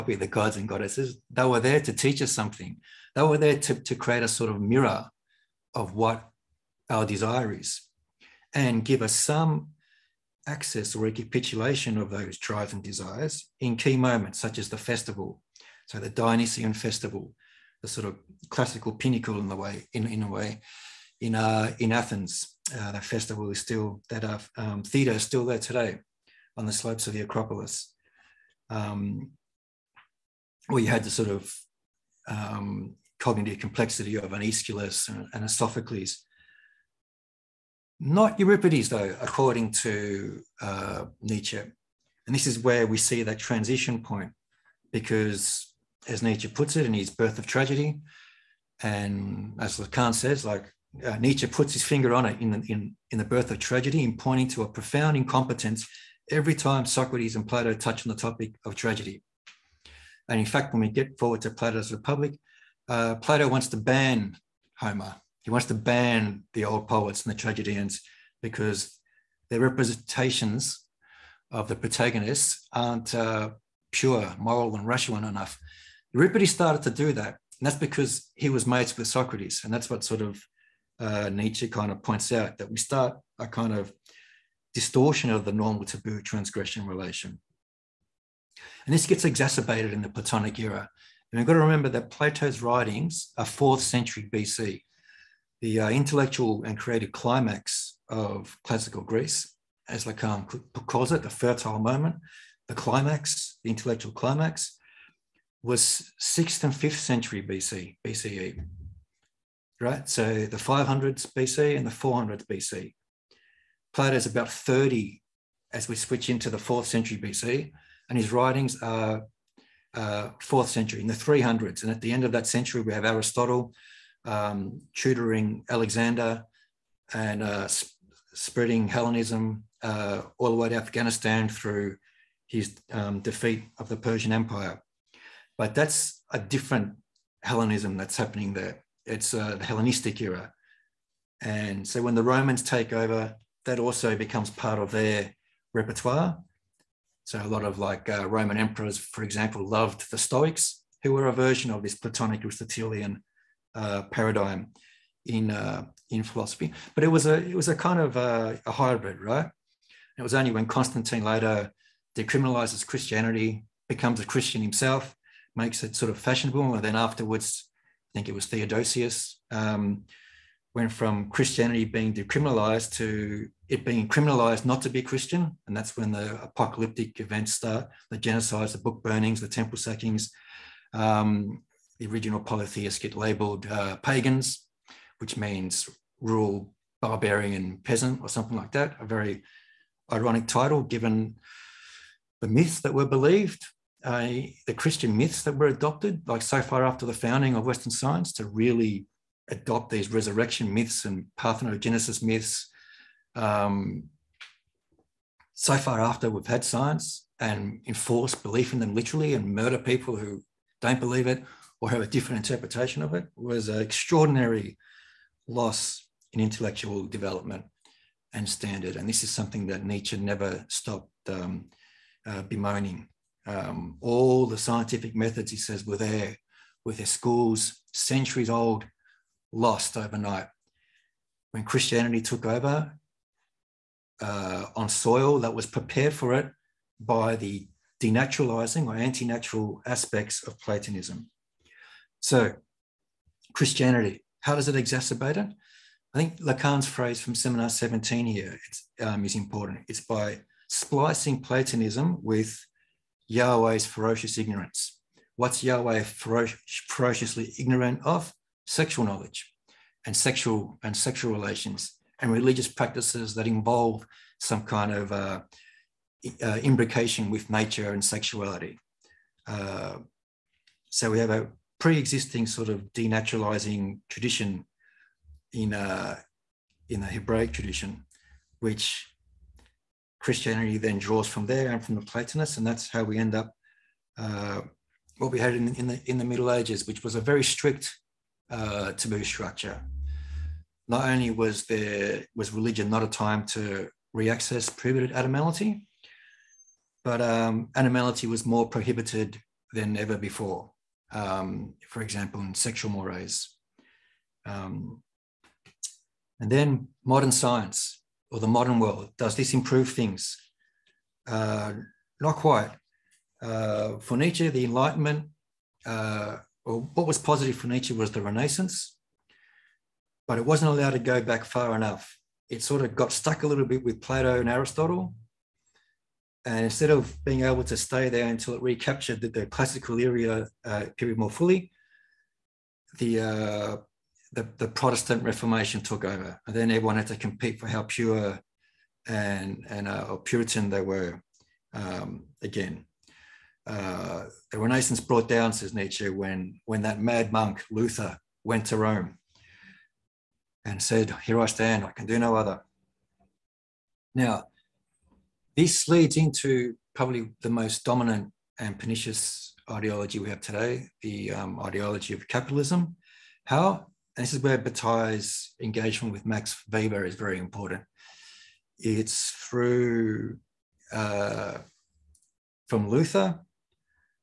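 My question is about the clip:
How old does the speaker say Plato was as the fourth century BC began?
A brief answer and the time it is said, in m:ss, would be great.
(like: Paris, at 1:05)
30, at 1:54.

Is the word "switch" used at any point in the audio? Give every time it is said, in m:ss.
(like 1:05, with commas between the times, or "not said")
1:55.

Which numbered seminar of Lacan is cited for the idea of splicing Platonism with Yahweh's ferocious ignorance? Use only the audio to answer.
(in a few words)
Seminar 17.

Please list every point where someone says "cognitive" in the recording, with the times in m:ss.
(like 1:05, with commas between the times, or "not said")
0:33.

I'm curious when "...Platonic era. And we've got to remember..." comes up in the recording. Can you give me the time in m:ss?
1:30.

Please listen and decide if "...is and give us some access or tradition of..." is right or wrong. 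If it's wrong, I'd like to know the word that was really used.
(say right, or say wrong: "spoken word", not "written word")
wrong: "recapitulation", not "tradition".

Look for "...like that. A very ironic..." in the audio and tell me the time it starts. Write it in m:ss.
3:08.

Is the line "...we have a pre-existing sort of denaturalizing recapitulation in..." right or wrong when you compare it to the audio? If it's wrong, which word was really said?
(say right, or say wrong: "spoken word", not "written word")
wrong: "tradition", not "recapitulation".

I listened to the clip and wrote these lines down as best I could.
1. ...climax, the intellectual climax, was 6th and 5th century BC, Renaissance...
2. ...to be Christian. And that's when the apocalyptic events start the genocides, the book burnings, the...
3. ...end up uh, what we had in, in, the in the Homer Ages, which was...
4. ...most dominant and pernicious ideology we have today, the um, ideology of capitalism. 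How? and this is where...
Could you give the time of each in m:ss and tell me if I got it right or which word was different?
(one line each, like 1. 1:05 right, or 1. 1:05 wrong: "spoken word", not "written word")
1. 1:42 wrong: "BCE", not "Renaissance"
2. 2:54 right
3. 4:43 wrong: "Middle", not "Homer"
4. 5:57 right.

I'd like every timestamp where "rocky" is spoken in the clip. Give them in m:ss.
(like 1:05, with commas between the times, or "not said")
not said.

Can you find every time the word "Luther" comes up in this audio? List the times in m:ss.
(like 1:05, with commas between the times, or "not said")
5:47, 6:12.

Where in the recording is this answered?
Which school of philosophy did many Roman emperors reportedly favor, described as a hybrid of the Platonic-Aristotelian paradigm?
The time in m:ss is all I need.
2:30.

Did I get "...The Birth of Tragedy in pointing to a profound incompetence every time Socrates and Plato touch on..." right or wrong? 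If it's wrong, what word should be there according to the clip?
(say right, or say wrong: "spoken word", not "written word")
right.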